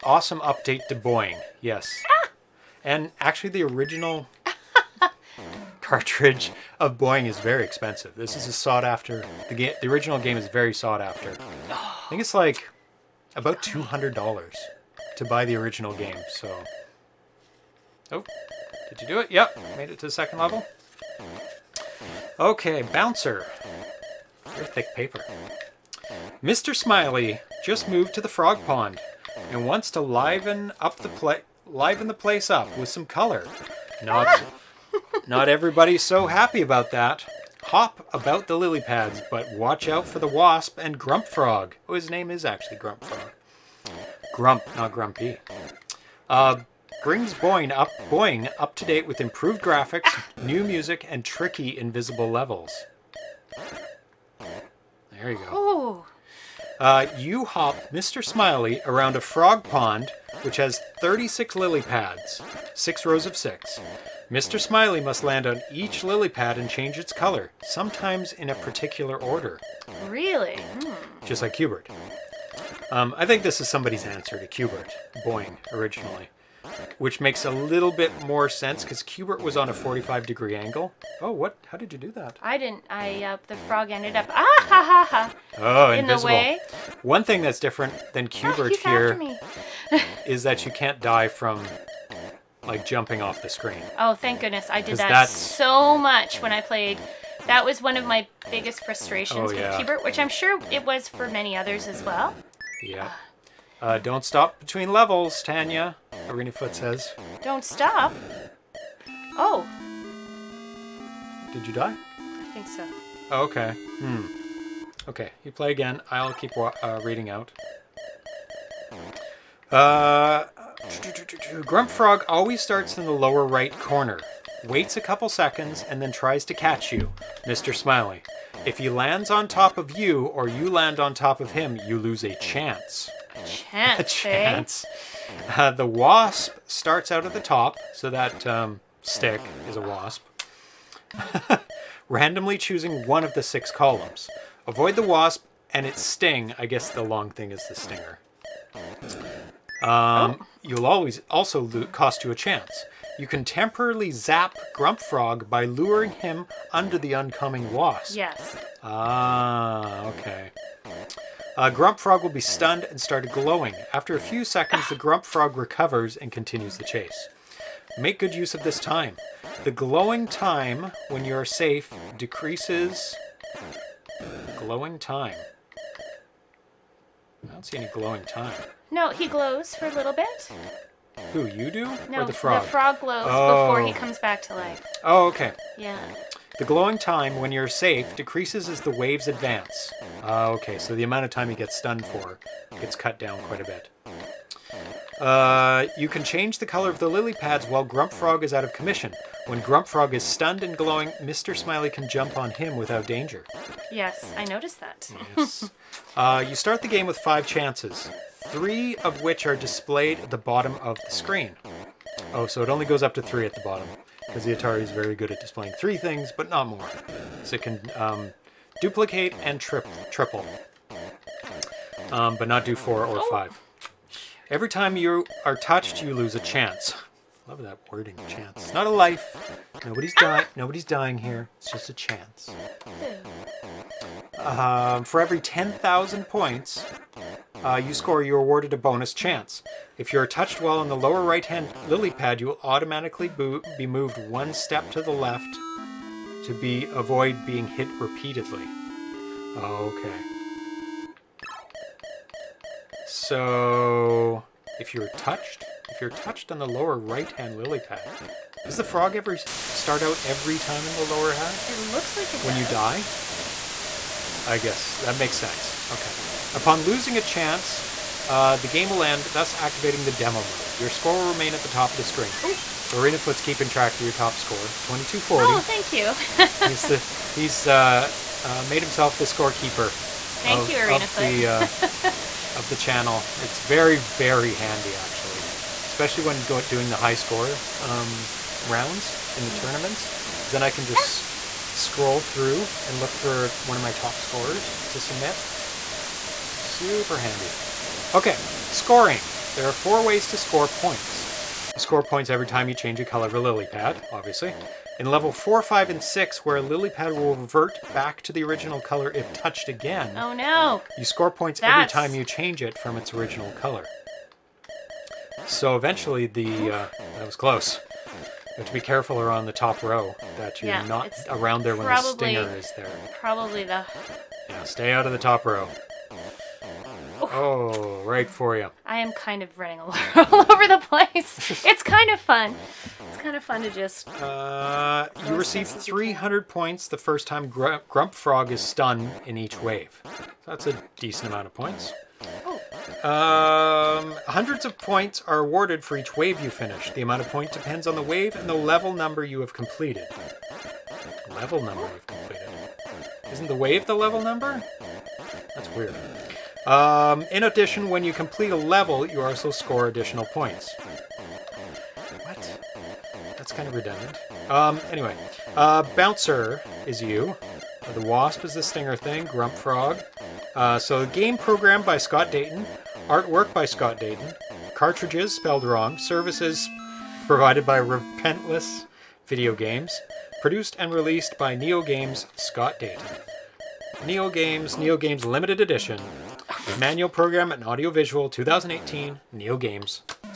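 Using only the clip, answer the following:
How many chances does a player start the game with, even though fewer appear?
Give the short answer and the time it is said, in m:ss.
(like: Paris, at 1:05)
5, at 3:27.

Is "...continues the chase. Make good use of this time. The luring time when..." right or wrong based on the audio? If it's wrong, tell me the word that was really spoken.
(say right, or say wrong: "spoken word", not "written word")
wrong: "glowing", not "luring".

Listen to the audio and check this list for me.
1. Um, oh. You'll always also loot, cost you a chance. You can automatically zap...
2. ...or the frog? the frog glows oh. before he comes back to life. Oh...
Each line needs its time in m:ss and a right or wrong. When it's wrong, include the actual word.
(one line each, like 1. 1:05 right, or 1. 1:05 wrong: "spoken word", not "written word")
1. 2:29 wrong: "temporarily", not "automatically"
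2. 3:02 right.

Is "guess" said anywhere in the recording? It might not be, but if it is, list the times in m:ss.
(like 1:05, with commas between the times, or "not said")
2:26, 4:24.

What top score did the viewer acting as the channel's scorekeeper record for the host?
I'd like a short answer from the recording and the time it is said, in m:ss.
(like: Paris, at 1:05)
2240, at 4:34.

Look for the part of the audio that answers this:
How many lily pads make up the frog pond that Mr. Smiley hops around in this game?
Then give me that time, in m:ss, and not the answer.
1:00.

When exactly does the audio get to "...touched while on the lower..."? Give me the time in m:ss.
4:00.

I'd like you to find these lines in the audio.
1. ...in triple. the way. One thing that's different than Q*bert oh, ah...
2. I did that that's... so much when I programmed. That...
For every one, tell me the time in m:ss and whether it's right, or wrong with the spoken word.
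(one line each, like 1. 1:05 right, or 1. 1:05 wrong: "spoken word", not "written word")
1. 1:25 wrong: "invisible", not "triple"
2. 1:34 wrong: "played", not "programmed".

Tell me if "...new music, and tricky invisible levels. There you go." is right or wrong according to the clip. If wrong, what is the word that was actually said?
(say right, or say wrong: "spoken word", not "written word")
right.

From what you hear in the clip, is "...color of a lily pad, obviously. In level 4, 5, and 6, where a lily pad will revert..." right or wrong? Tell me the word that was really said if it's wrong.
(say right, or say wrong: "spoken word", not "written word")
right.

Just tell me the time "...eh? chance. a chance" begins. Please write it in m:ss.
2:13.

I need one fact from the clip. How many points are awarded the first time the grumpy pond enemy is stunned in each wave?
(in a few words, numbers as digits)
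300.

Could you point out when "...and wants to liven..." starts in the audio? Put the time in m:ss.
0:29.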